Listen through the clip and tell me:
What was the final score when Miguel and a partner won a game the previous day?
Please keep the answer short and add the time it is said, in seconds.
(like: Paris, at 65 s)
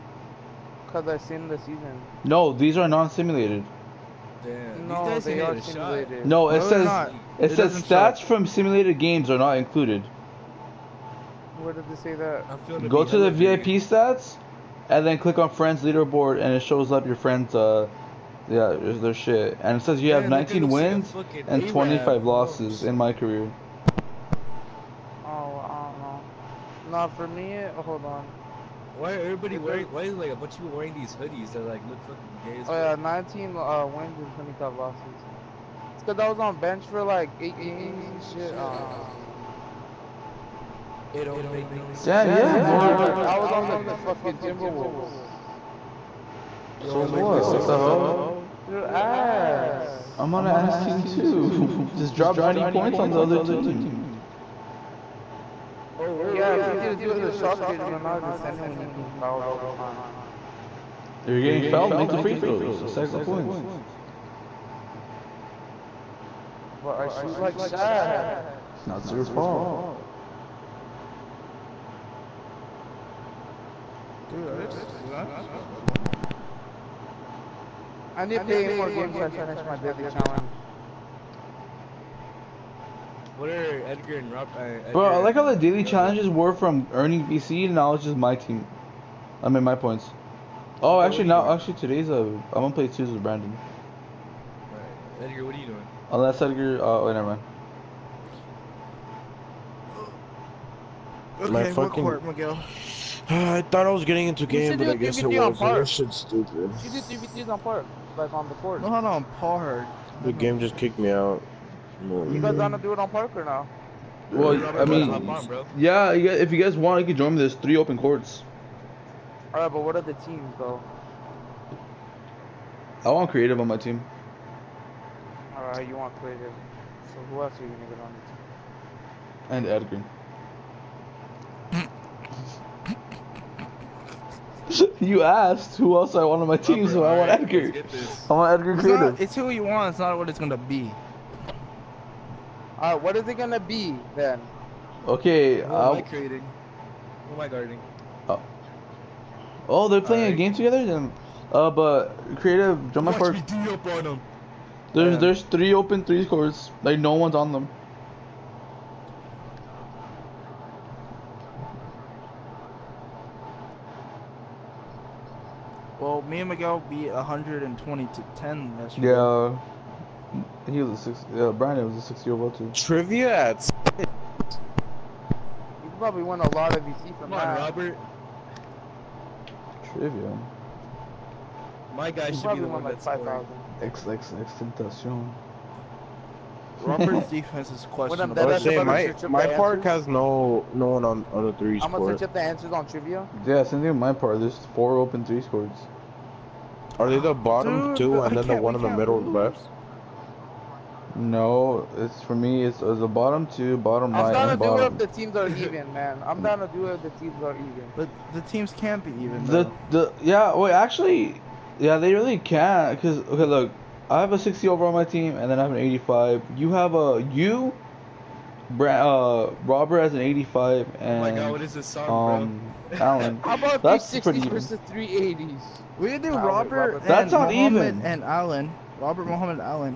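120 to 10, at 167 s.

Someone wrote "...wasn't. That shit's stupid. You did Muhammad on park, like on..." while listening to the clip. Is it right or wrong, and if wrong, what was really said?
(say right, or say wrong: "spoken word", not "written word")
wrong: "DVDs", not "Muhammad".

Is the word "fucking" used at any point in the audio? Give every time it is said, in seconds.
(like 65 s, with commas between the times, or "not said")
32 s, 44 s, 101 s.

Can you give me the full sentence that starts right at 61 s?
If you're getting fouled, make the free throws.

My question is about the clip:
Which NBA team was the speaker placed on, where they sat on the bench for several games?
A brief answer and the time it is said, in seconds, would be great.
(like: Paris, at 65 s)
Timberwolves, at 44 s.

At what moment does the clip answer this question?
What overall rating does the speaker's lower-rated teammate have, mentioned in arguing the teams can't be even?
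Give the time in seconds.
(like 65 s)
214 s.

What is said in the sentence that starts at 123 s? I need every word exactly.
I want creative on my team.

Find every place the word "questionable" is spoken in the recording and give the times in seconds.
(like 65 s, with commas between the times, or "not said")
187 s.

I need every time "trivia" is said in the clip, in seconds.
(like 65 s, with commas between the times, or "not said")
172 s, 179 s, 192 s.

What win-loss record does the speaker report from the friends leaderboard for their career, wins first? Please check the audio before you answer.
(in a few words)
19-25.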